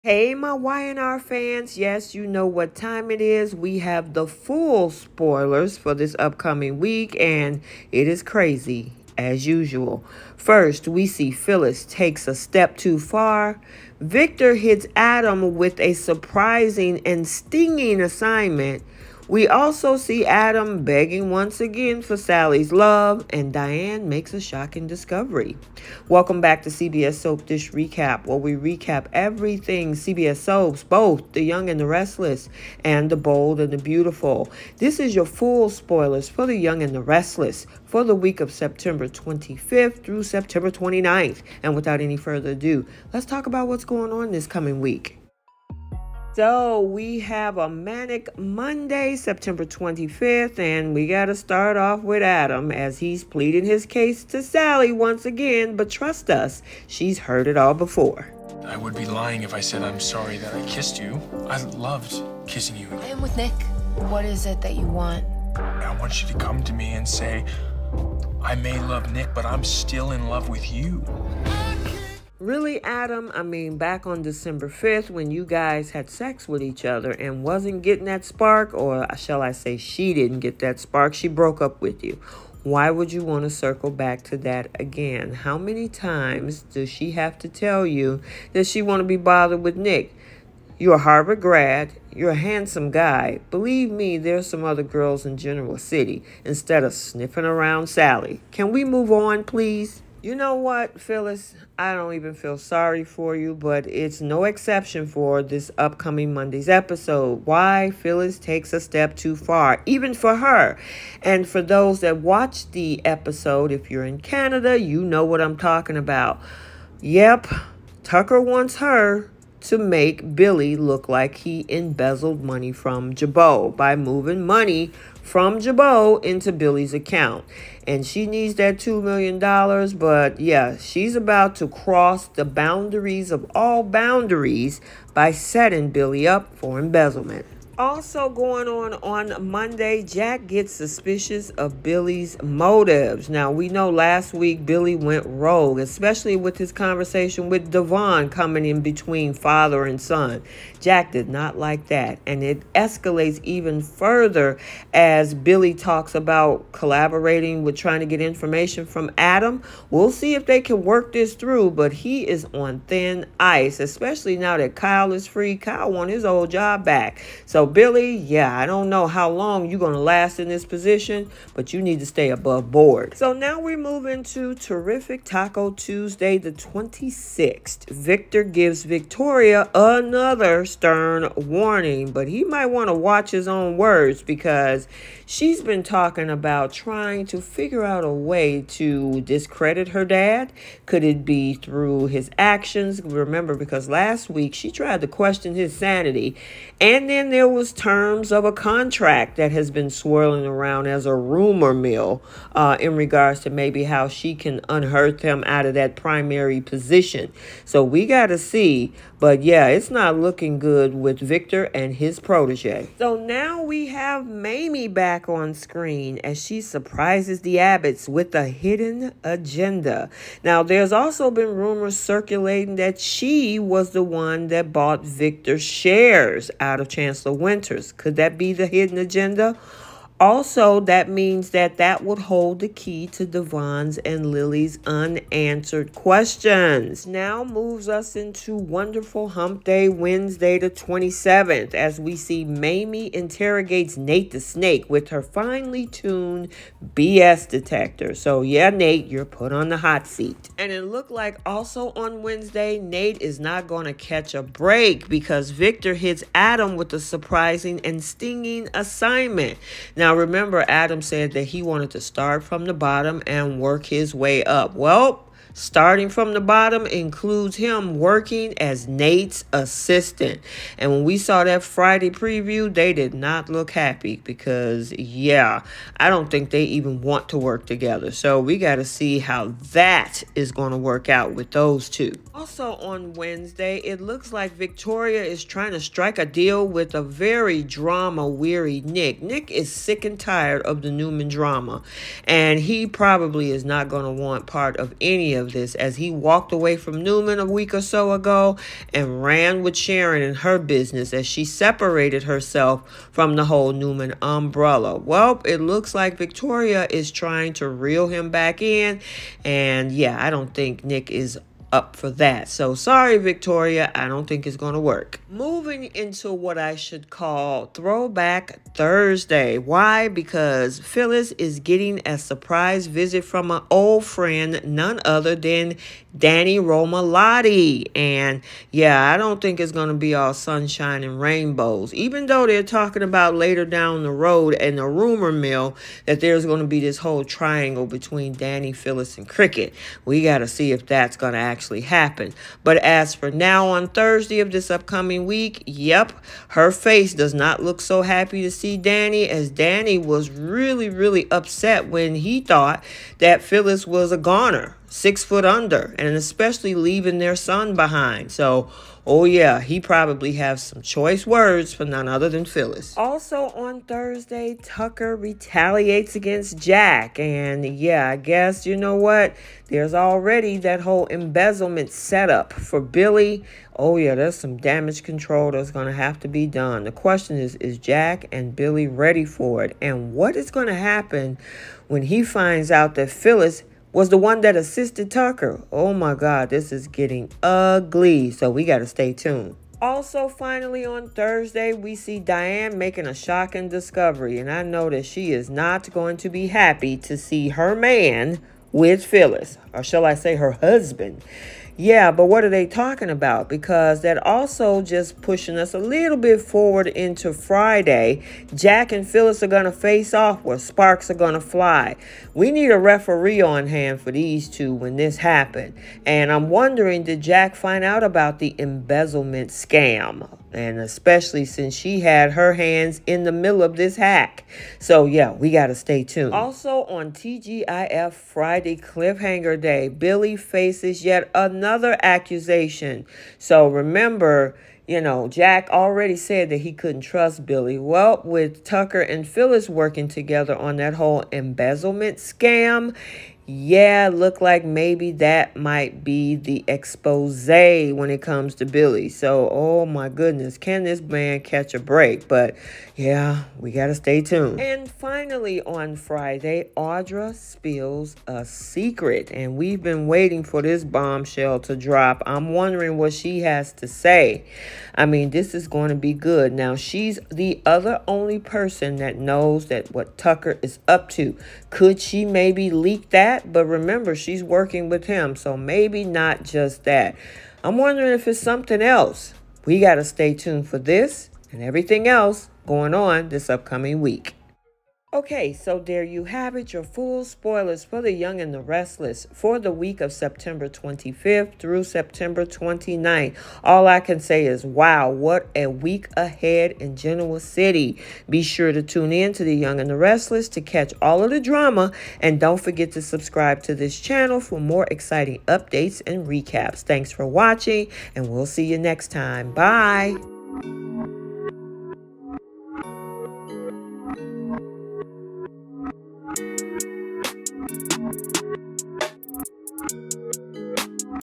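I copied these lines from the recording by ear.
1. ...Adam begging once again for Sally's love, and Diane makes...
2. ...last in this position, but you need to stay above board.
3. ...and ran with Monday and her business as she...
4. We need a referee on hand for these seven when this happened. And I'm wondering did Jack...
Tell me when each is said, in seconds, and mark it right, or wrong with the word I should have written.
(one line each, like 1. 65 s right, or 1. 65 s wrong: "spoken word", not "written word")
1. 20 s right
2. 169 s right
3. 298 s wrong: "Sharon", not "Monday"
4. 412 s wrong: "two", not "seven".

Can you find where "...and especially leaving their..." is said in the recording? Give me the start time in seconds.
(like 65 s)
355 s.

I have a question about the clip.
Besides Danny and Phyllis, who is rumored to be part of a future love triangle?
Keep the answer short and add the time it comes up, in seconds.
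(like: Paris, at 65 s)
Cricket, at 339 s.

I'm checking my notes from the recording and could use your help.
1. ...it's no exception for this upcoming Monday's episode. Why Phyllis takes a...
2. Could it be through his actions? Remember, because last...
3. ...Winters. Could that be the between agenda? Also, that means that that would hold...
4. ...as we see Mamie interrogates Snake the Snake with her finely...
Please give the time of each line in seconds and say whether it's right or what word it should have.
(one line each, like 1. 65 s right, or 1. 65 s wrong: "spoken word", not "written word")
1. 103 s right
2. 190 s right
3. 227 s wrong: "hidden", not "between"
4. 241 s wrong: "Nate", not "Snake".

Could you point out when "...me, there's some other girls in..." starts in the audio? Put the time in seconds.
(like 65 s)
93 s.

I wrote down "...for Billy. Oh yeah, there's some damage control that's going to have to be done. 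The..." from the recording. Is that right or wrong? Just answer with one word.
right.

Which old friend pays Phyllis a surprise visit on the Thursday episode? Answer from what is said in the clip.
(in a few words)
Danny Romalotti.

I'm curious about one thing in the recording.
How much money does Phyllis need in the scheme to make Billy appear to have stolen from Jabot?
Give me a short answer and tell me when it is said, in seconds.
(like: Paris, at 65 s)
$2 million, at 128 s.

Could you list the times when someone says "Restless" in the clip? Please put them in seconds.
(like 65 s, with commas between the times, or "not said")
31 s, 37 s, 488 s, 499 s.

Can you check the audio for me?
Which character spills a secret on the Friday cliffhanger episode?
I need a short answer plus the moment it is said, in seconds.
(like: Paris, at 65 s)
Audra, at 456 s.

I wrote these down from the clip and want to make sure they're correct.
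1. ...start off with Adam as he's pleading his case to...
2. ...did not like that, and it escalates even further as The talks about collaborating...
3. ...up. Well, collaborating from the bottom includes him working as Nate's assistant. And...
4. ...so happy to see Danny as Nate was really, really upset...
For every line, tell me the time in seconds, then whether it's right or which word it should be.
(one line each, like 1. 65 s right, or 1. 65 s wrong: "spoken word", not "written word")
1. 51 s right
2. 151 s wrong: "Billy", not "The"
3. 264 s wrong: "starting", not "collaborating"
4. 347 s wrong: "Danny", not "Nate".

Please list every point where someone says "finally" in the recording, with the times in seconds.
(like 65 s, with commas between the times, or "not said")
390 s, 454 s.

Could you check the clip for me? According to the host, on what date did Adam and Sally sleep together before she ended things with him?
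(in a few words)
December 5th.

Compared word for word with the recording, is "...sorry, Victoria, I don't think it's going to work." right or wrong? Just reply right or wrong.
right.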